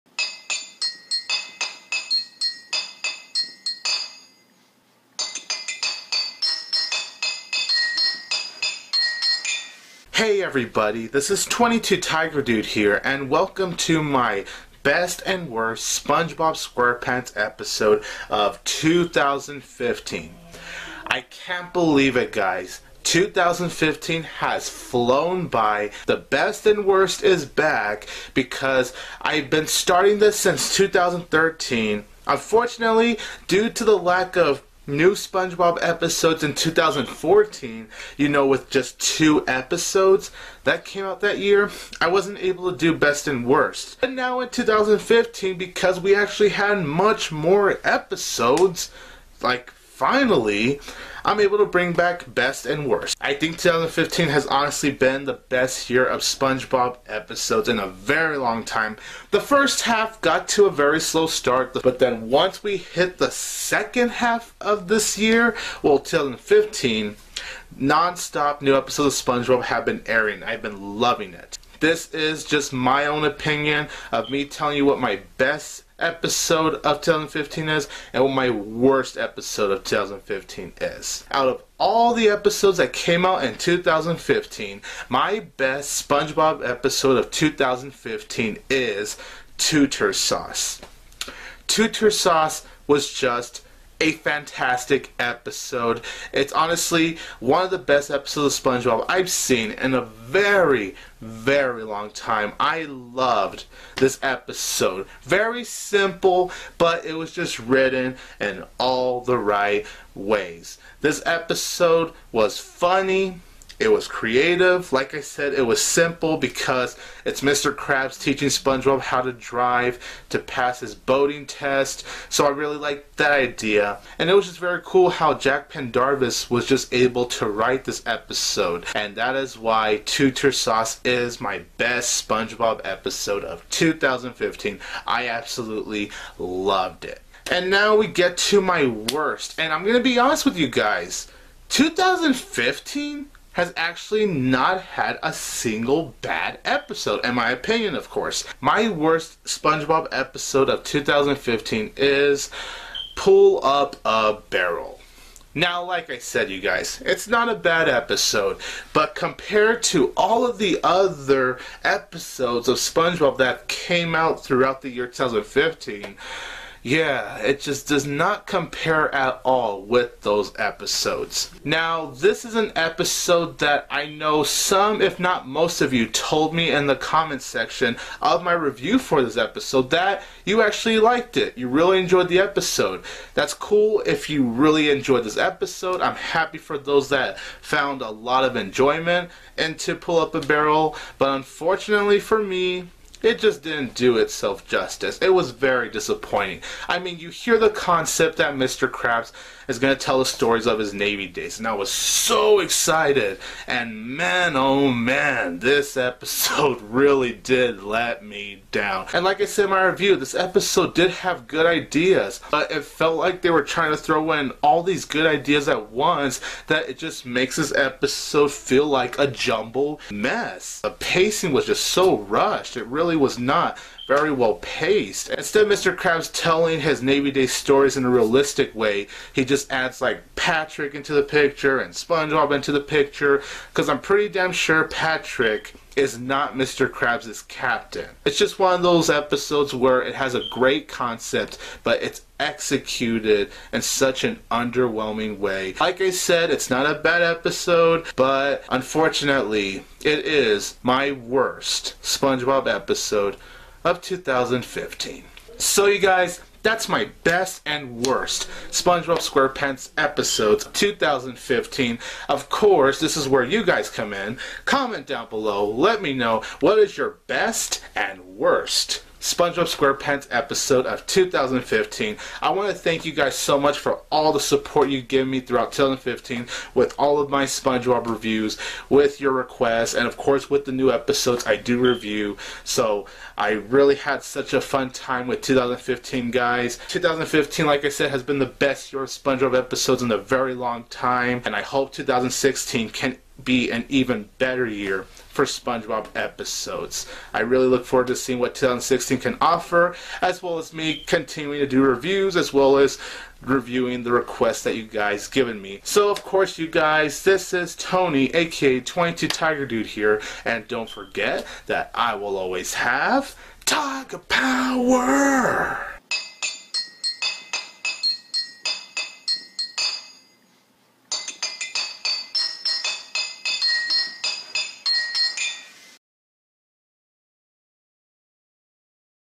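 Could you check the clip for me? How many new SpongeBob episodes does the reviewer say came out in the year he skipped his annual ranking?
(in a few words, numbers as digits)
2.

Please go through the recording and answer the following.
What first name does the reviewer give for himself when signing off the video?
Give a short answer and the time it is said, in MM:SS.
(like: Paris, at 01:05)
Tony, at 05:07.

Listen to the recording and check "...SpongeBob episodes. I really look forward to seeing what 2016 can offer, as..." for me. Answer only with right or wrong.
right.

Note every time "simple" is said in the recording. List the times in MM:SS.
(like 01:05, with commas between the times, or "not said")
01:45, 01:55.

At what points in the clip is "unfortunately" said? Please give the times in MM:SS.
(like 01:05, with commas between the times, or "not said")
00:32, 03:11, 04:08.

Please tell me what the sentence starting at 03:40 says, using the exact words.
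The pacing was just so rushed.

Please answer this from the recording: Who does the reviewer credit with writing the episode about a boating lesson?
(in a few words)
Jack Pendarvis.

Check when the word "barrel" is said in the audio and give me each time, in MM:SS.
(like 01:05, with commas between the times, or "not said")
02:34, 03:10.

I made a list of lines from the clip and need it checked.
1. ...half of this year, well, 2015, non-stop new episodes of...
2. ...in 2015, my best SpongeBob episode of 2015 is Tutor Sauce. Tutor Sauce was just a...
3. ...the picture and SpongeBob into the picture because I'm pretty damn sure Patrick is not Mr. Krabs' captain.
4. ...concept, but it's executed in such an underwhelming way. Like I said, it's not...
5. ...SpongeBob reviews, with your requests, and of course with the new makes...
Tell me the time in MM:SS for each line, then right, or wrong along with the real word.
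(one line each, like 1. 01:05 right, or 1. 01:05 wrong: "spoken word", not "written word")
1. 01:04 right
2. 01:23 right
3. 03:51 right
4. 04:00 right
5. 04:37 wrong: "episodes", not "makes".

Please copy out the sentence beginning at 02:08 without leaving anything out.
And that is why Tutor Sauce is my best SpongeBob episode of 2015.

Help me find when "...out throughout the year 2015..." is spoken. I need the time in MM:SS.
02:44.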